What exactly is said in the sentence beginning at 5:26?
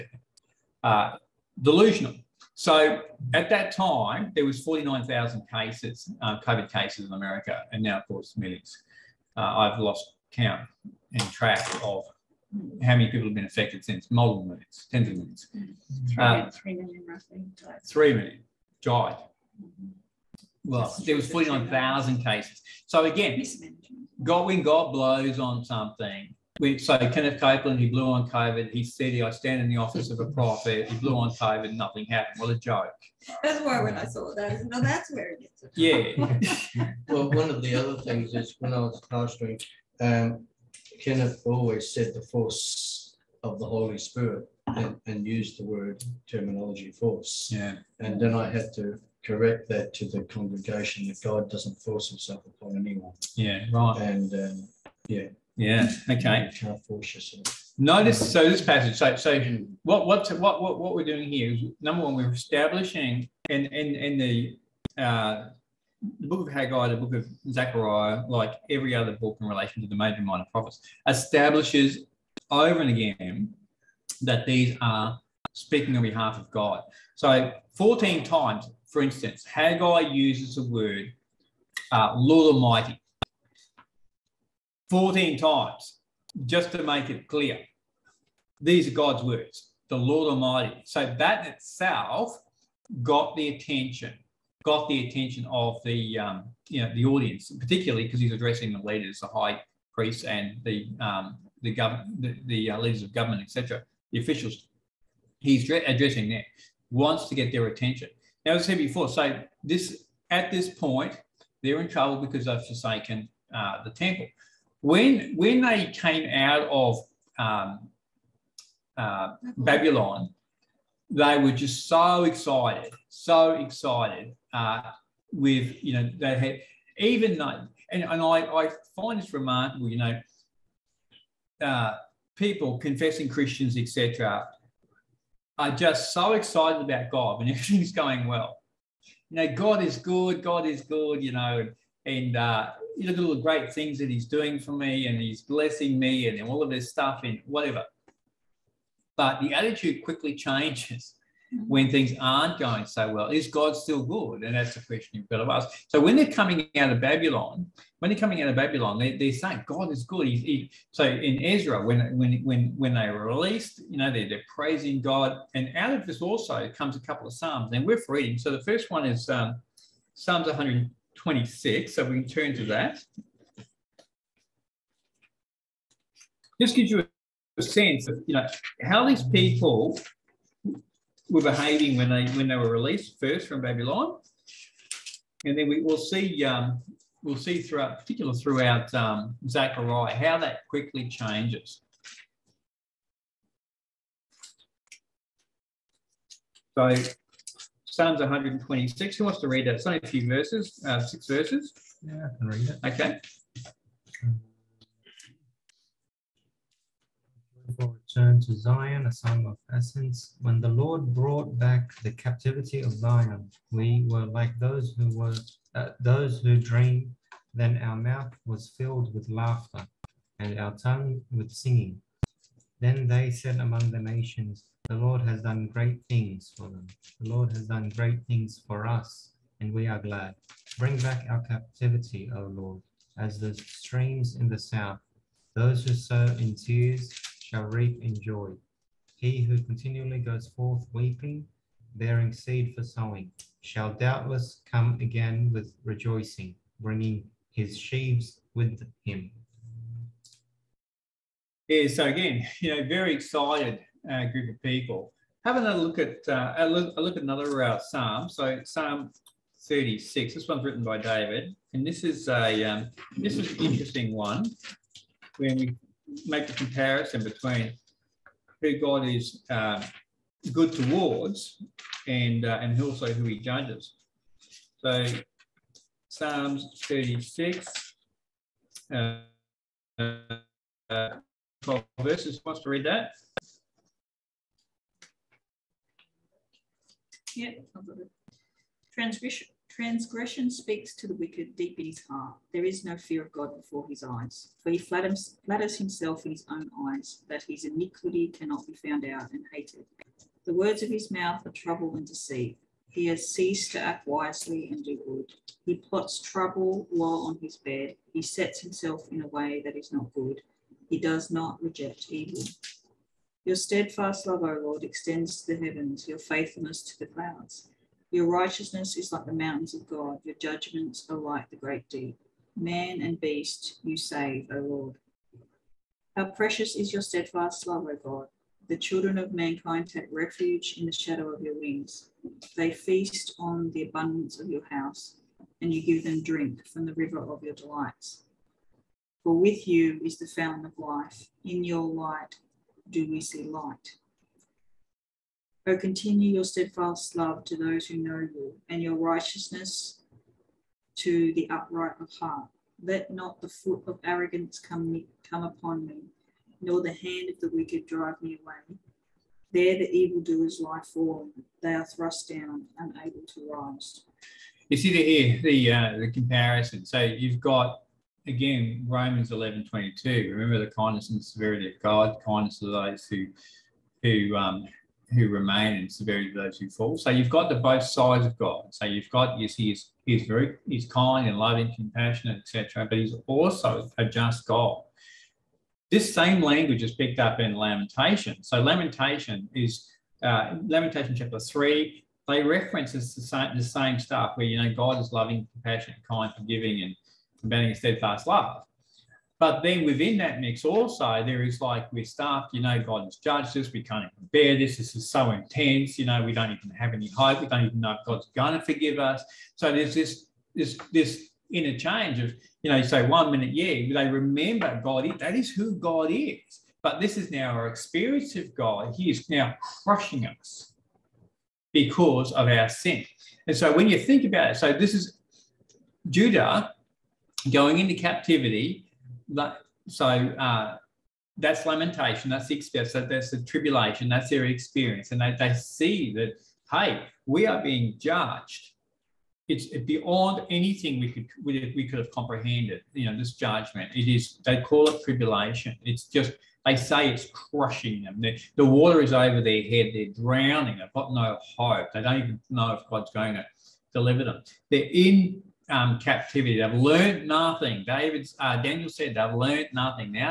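How precious is your steadfast love, O God.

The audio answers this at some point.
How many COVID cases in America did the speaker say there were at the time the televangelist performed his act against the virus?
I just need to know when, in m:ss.
0:04.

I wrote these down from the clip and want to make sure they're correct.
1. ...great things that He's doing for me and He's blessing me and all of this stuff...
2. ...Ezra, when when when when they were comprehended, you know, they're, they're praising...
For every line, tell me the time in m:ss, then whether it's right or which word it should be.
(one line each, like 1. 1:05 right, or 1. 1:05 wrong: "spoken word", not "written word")
1. 2:23 right
2. 2:41 wrong: "released", not "comprehended".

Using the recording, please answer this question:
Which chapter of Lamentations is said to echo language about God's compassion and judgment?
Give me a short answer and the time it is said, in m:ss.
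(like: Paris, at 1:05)
Chapter 3, at 6:31.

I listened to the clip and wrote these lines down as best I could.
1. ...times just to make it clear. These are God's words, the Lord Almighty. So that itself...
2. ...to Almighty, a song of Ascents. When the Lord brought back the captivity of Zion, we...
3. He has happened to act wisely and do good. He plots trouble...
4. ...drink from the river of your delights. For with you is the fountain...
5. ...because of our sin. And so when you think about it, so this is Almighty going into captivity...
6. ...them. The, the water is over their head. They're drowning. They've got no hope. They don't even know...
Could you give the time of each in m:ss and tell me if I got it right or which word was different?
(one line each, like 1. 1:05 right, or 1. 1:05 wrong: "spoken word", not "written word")
1. 1:25 right
2. 3:28 wrong: "Zion", not "Almighty"
3. 5:02 wrong: "ceased", not "happened"
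4. 5:36 right
5. 7:01 wrong: "Judah", not "Almighty"
6. 7:28 right.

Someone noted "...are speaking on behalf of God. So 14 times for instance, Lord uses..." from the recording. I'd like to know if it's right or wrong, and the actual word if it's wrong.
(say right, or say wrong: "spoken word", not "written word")
wrong: "Haggai", not "Lord".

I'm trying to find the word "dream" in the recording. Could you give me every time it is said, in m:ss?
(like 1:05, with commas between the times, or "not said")
3:36.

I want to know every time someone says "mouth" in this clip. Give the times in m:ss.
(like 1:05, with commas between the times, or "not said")
3:37, 5:01.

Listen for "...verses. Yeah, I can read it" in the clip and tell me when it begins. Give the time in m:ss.
3:21.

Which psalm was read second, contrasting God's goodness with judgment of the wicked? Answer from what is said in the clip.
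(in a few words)
Psalm 36.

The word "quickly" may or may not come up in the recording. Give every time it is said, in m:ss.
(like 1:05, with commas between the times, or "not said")
2:30, 3:10.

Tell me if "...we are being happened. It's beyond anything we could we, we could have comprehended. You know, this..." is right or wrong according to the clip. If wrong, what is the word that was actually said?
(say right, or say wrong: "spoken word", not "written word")
wrong: "judged", not "happened".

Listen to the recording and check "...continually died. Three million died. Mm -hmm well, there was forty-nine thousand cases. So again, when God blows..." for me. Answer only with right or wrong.
wrong.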